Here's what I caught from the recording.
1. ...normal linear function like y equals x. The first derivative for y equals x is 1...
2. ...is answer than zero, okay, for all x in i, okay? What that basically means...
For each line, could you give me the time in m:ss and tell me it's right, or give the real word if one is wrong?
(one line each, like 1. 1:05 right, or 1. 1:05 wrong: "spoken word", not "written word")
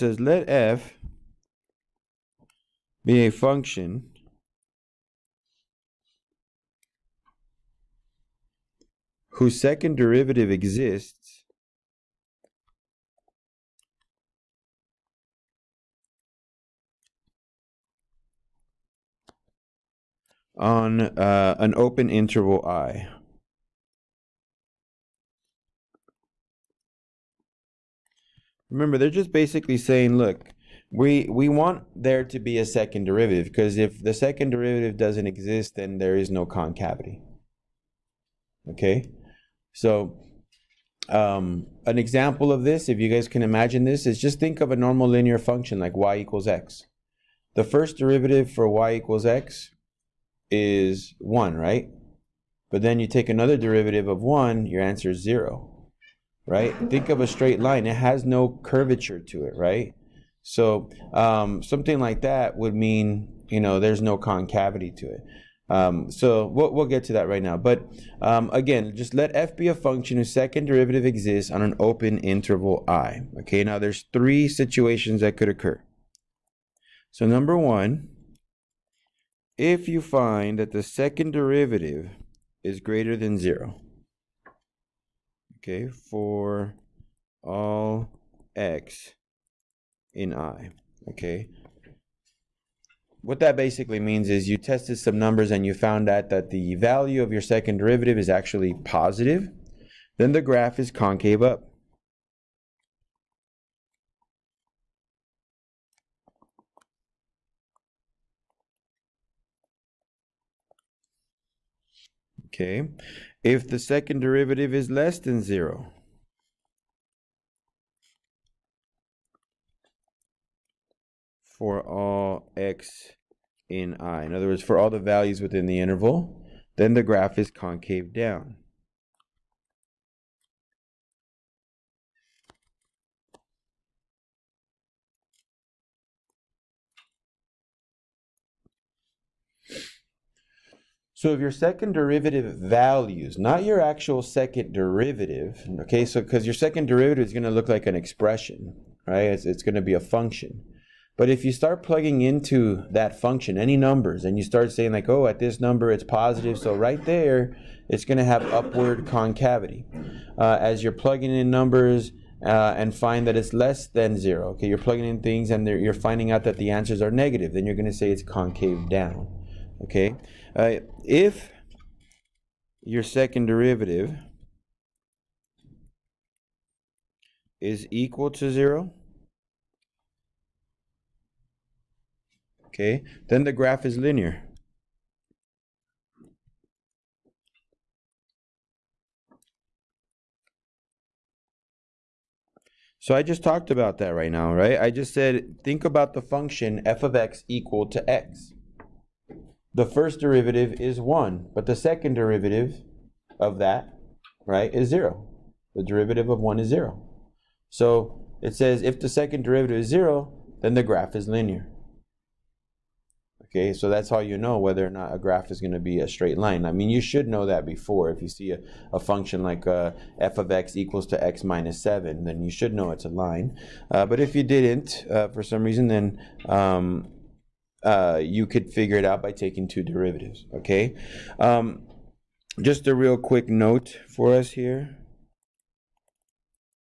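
1. 0:44 right
2. 1:22 wrong: "greater", not "answer".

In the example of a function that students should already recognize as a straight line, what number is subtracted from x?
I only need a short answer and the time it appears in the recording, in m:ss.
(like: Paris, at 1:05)
7, at 3:41.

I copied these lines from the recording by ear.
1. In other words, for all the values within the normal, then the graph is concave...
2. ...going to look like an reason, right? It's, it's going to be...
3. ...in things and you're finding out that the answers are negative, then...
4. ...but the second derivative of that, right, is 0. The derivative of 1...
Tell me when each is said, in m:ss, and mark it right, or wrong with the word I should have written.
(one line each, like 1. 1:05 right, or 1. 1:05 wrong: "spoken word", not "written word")
1. 2:04 wrong: "interval", not "normal"
2. 2:27 wrong: "expression", not "reason"
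3. 2:45 right
4. 3:21 right.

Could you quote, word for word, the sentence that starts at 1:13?
Okay, now there's three situations that could occur.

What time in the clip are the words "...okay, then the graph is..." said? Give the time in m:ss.
3:02.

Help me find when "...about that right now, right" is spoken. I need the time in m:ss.
3:13.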